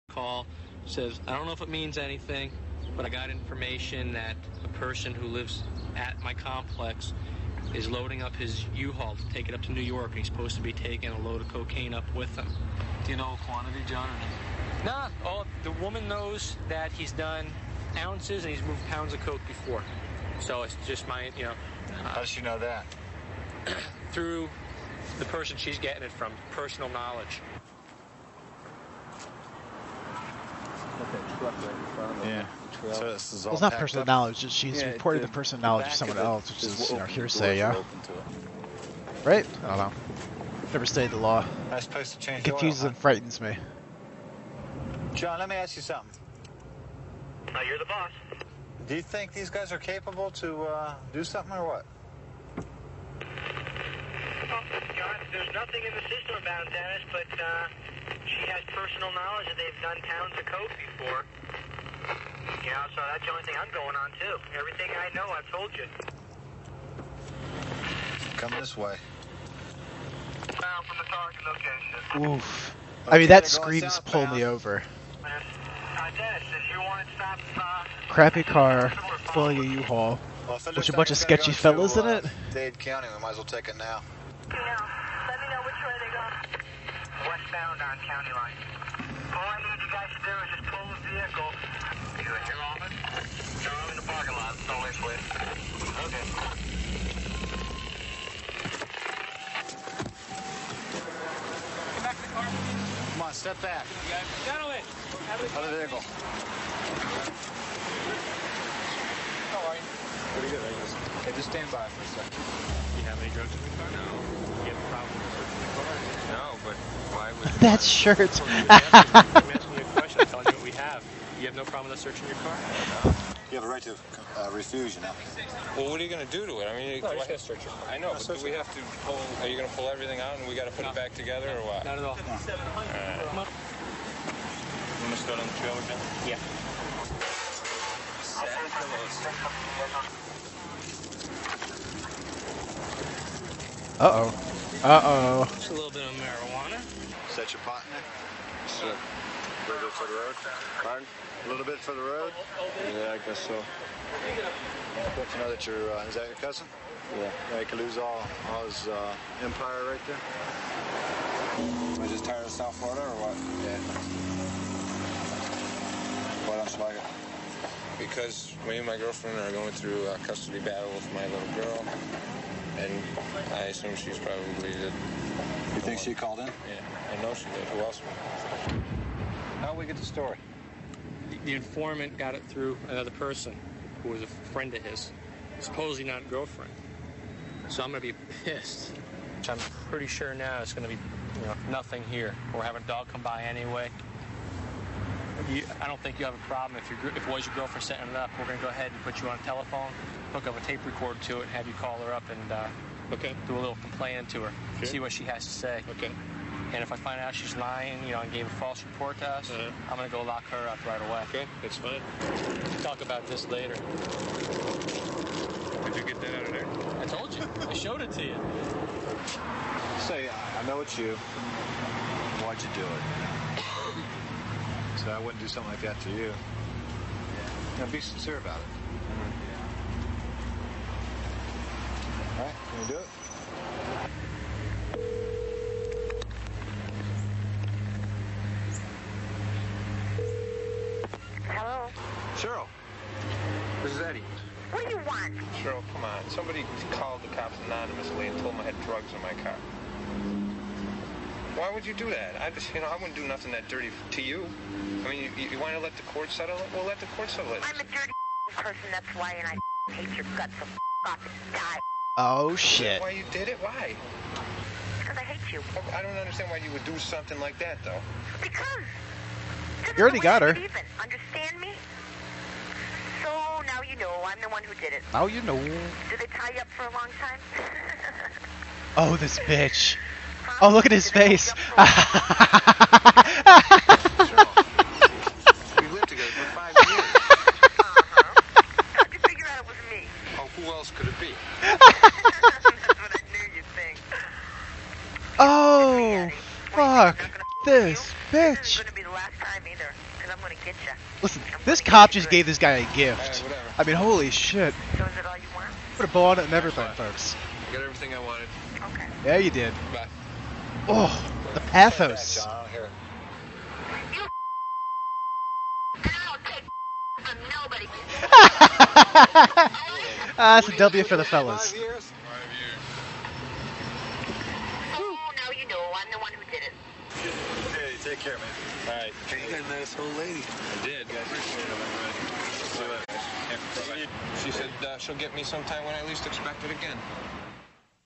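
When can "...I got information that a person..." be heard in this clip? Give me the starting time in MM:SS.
00:03.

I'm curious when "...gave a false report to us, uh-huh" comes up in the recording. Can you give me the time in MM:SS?
03:28.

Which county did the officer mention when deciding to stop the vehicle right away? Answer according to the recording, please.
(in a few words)
Dade County.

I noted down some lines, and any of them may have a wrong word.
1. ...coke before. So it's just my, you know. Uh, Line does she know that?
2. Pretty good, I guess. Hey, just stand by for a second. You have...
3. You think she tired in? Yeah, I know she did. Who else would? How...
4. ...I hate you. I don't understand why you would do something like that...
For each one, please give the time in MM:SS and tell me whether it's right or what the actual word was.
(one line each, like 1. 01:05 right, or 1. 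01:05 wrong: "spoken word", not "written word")
1. 00:19 wrong: "How", not "Line"
2. 01:50 right
3. 02:54 wrong: "called", not "tired"
4. 04:25 right.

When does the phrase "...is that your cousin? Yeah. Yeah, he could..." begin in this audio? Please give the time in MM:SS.
02:36.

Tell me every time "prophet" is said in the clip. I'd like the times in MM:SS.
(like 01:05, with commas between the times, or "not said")
not said.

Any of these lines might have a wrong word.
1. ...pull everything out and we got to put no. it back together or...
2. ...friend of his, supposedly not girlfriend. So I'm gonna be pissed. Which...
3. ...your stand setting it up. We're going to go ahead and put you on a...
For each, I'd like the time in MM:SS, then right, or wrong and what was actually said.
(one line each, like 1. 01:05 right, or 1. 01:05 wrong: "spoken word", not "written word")
1. 02:09 right
2. 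03:04 right
3. 03:17 wrong: "girlfriend", not "stand".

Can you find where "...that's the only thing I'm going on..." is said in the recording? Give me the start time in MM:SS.
01:03.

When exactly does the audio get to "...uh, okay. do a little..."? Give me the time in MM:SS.
03:22.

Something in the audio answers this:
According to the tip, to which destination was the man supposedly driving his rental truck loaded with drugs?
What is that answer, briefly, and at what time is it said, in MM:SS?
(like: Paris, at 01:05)
New York, at 00:09.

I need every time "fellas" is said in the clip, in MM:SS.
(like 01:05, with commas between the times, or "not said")
01:21, 05:21.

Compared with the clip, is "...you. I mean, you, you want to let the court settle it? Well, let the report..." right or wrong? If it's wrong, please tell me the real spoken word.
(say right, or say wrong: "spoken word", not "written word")
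wrong: "court", not "report".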